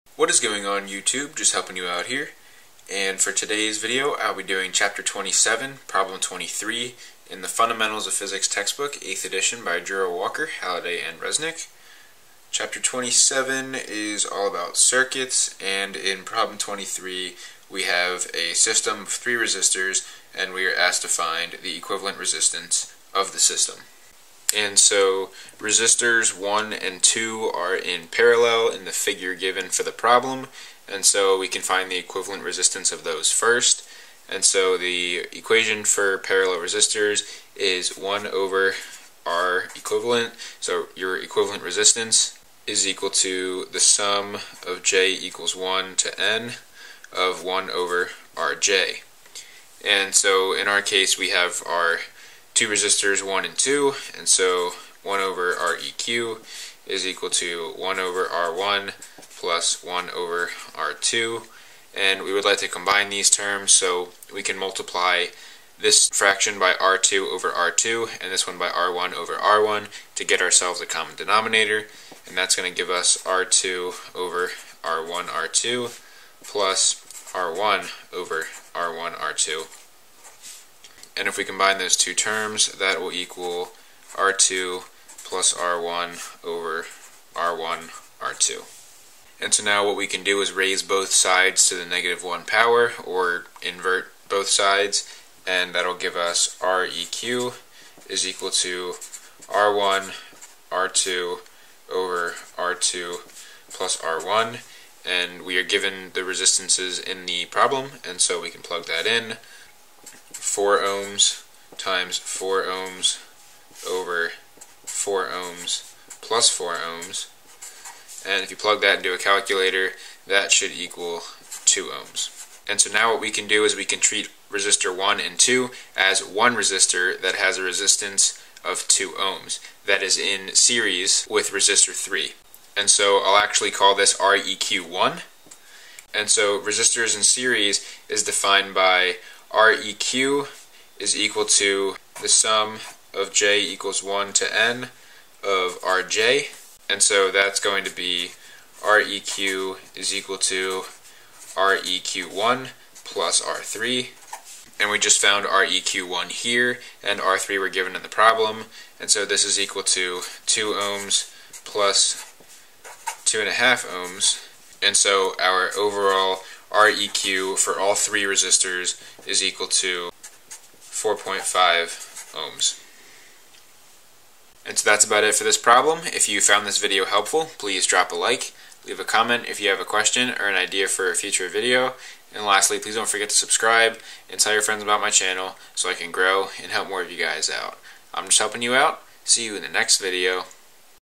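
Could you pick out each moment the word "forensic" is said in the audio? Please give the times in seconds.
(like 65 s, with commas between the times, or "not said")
not said.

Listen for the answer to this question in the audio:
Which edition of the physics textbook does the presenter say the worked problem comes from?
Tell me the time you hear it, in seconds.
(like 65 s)
8 s.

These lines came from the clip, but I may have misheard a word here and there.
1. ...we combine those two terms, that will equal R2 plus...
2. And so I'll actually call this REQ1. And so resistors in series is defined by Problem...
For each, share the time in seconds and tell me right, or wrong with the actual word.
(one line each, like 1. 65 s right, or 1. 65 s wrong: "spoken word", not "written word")
1. 81 s right
2. 132 s wrong: "REQ", not "Problem".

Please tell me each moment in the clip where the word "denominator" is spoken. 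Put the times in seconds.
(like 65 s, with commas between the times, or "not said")
71 s.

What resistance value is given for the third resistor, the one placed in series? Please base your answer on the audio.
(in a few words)
2.5 ohms.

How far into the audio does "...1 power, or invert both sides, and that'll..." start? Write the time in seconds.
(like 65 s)
92 s.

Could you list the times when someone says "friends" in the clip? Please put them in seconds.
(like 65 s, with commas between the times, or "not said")
184 s.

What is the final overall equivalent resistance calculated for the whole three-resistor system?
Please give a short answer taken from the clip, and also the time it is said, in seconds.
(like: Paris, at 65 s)
4.5 ohms, at 170 s.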